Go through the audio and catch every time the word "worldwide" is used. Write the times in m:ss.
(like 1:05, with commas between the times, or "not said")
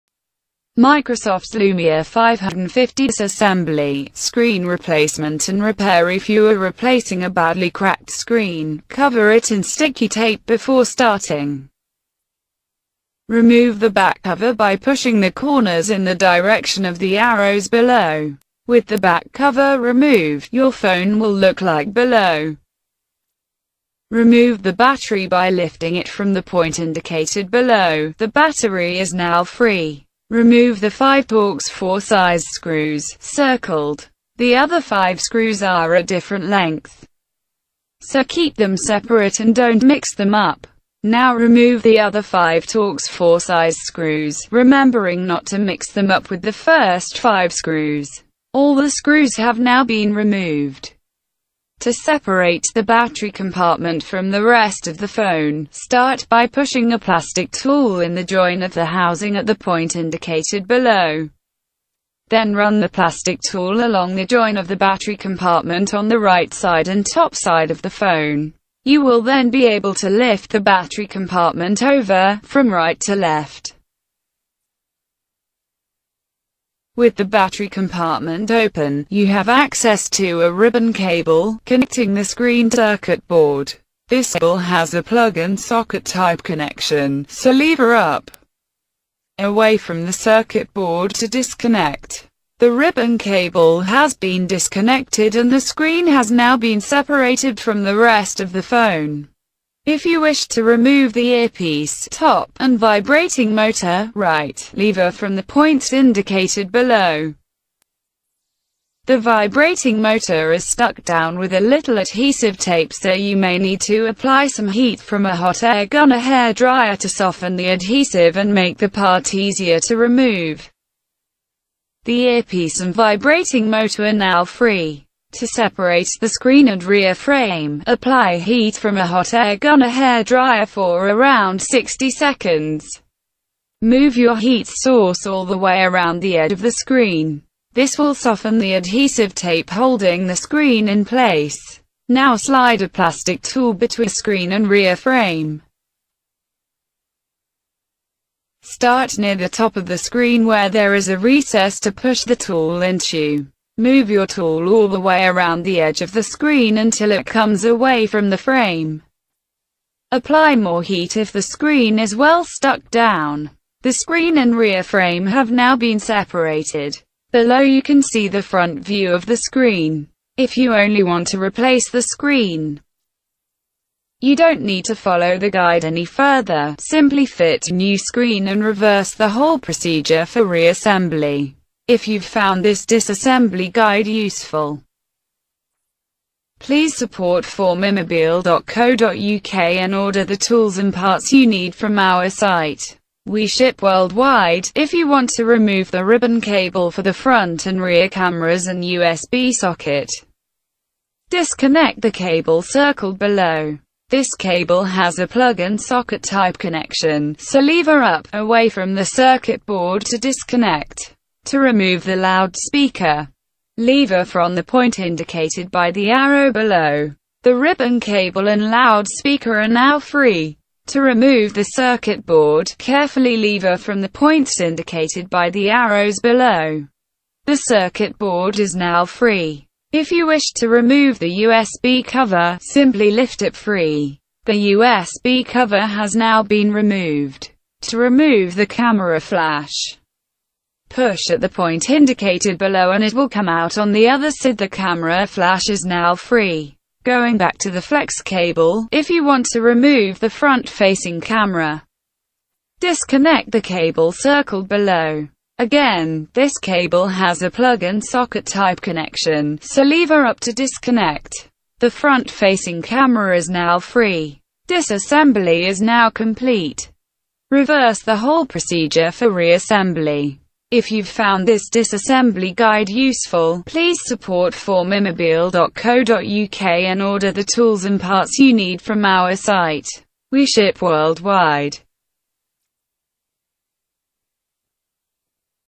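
3:13, 4:40.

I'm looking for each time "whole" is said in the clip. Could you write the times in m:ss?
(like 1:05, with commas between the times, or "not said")
2:59, 4:28.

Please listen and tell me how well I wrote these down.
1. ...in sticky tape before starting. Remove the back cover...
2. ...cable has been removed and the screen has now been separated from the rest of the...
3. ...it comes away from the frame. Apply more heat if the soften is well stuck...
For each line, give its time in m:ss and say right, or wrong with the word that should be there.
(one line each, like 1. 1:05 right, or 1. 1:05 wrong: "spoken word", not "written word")
1. 0:09 right
2. 1:33 wrong: "disconnected", not "removed"
3. 2:37 wrong: "screen", not "soften".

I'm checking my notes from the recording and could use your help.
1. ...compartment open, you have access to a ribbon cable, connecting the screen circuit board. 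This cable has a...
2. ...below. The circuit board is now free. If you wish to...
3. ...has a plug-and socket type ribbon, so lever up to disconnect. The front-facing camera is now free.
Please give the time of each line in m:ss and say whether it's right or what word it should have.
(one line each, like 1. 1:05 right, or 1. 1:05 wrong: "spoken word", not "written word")
1. 1:17 right
2. 3:46 right
3. 4:17 wrong: "connection", not "ribbon".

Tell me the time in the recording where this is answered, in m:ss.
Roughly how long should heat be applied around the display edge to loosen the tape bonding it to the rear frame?
2:11.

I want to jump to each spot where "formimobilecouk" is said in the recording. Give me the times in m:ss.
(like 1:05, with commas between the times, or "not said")
3:07, 4:34.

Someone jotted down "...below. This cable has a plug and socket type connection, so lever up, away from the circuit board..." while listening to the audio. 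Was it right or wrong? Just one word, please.
right.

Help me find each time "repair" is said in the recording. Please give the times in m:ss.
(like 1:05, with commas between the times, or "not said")
0:05.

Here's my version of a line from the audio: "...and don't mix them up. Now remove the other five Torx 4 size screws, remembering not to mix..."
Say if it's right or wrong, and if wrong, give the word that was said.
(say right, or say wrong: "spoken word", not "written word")
right.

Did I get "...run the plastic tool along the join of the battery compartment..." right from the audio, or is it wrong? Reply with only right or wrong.
right.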